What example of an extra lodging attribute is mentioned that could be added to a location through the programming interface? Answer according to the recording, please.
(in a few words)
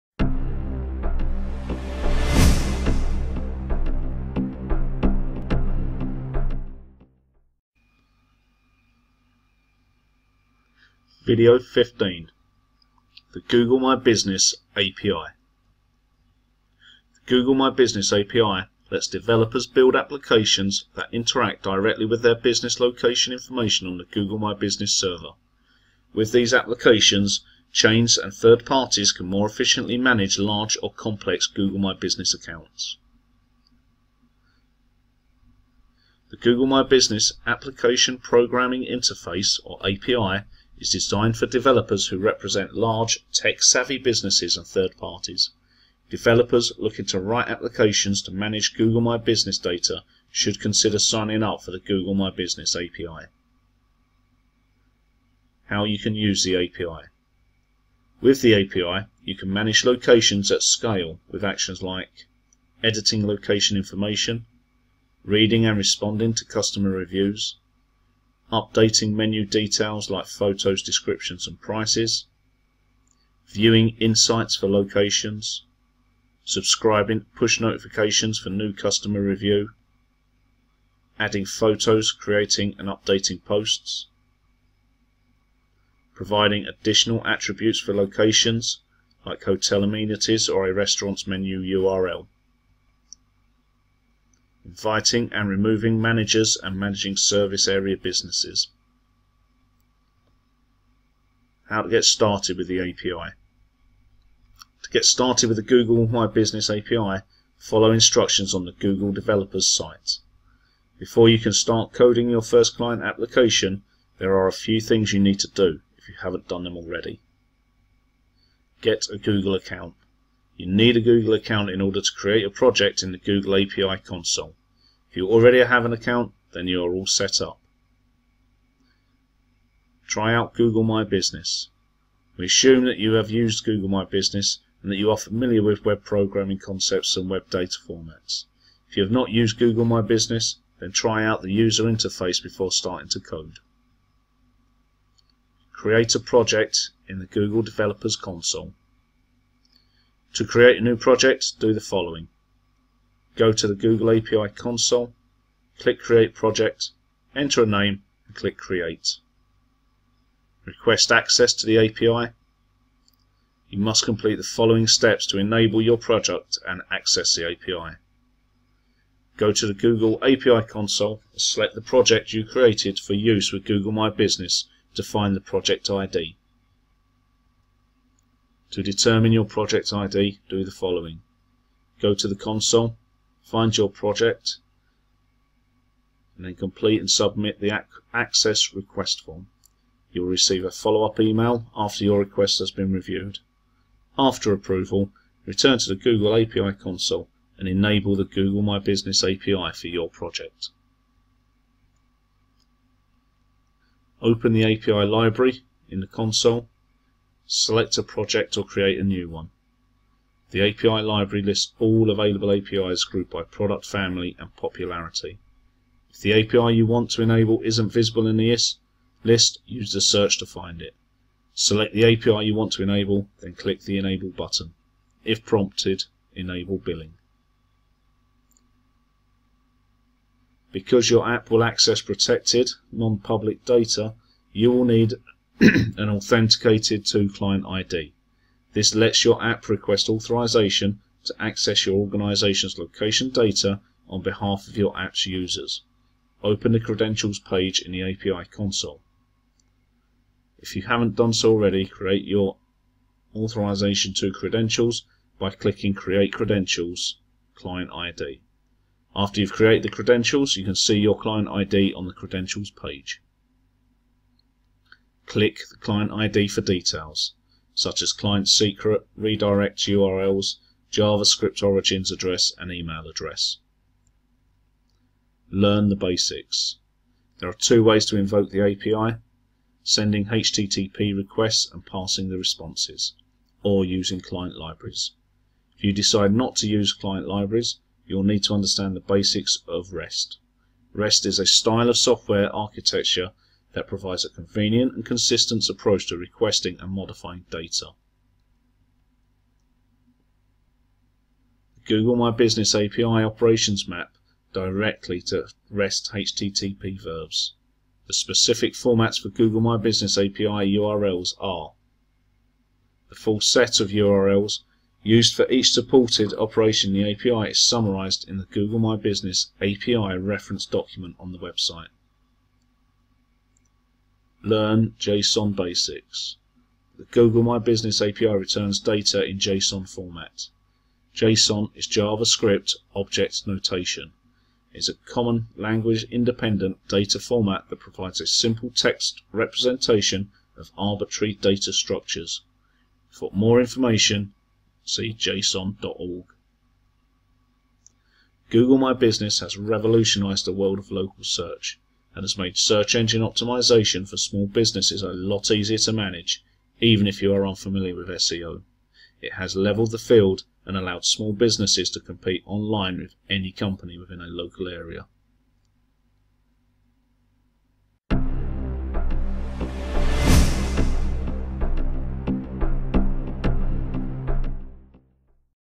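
hotel amenities.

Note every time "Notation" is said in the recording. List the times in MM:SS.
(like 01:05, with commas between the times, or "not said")
05:33.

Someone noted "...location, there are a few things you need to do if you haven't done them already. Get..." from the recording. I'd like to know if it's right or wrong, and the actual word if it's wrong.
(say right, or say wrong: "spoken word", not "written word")
wrong: "application", not "location".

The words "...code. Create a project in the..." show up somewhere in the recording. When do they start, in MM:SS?
02:23.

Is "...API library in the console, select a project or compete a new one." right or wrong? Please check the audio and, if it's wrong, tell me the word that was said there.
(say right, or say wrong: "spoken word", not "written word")
wrong: "create", not "compete".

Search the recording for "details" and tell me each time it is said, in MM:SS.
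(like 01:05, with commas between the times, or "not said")
01:09, 04:26.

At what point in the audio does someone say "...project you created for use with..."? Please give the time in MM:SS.
02:51.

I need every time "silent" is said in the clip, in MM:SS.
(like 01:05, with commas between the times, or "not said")
not said.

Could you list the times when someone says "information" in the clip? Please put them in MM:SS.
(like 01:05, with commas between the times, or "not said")
00:23, 01:03, 05:43.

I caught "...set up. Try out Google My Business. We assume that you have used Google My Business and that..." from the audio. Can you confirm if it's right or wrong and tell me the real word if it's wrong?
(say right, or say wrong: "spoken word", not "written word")
right.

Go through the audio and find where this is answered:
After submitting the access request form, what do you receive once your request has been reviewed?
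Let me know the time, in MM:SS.
03:10.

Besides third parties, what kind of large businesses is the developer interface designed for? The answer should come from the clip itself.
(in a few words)
tech-savvy.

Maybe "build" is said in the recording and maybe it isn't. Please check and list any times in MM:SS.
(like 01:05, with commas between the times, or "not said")
00:19.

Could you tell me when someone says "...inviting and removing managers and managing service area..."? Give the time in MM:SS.
01:34.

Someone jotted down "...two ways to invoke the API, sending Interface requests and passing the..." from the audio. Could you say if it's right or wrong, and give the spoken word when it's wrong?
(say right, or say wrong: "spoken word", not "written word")
wrong: "HTTP", not "Interface".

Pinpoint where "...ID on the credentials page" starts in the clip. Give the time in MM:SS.
04:21.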